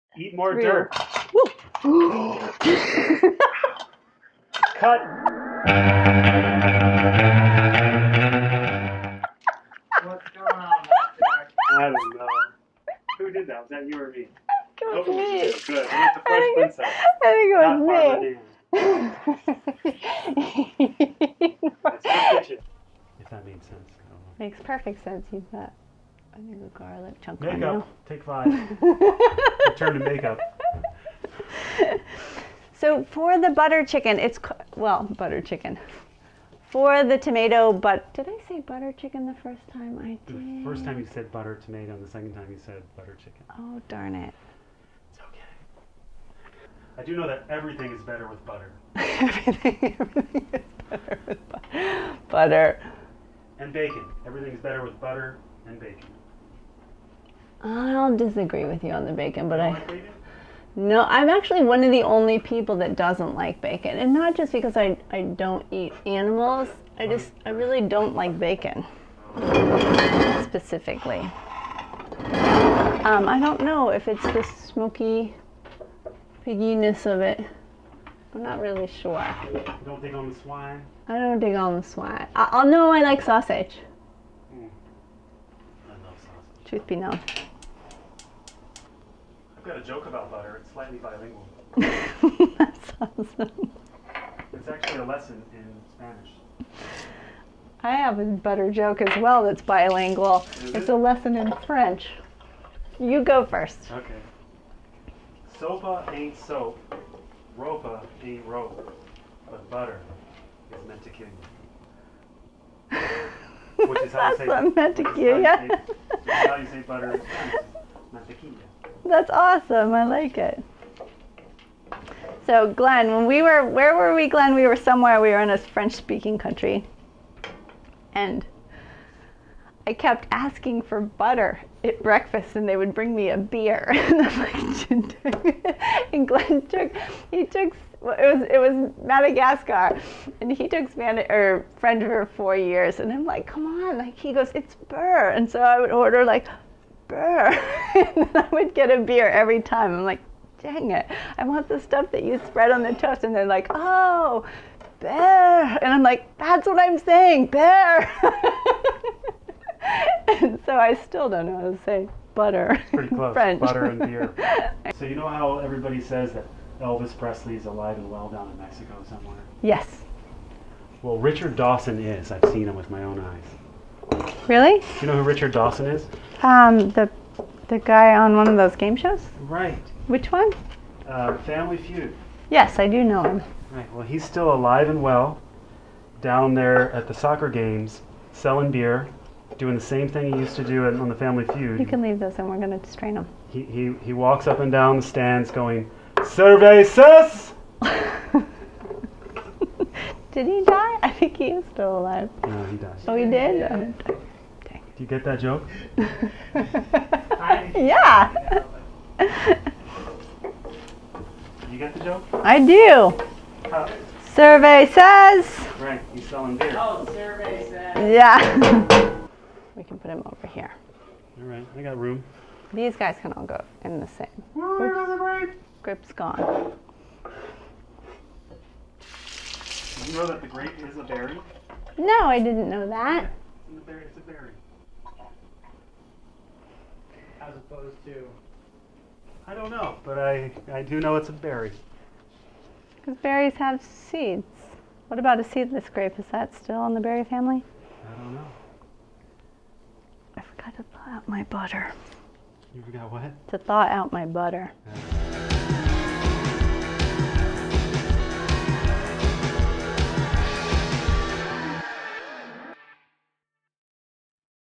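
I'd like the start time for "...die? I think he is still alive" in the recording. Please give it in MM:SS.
03:20.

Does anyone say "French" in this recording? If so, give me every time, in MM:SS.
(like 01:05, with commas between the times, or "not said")
01:41, 02:05, 02:21, 02:43.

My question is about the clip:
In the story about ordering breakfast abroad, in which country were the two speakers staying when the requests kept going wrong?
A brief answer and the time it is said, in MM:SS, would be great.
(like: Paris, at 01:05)
Madagascar, at 02:19.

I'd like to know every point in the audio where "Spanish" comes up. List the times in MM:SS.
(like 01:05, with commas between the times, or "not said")
01:35, 02:20.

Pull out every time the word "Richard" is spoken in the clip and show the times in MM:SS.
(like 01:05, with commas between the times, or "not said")
02:51, 02:55.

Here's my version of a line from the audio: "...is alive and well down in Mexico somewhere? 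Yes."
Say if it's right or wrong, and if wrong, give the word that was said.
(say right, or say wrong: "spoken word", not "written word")
right.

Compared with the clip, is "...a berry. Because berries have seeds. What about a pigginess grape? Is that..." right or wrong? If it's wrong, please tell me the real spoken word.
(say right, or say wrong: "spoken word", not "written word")
wrong: "seedless", not "pigginess".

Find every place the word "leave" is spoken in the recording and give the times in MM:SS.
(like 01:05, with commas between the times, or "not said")
03:12.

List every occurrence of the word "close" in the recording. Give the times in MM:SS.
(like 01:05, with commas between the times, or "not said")
02:43.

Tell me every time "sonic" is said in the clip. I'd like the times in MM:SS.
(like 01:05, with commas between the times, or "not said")
not said.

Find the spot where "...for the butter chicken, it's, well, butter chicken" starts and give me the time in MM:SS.
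00:33.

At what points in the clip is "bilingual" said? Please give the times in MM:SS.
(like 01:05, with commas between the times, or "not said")
01:30, 01:39.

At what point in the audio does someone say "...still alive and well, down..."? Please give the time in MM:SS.
03:04.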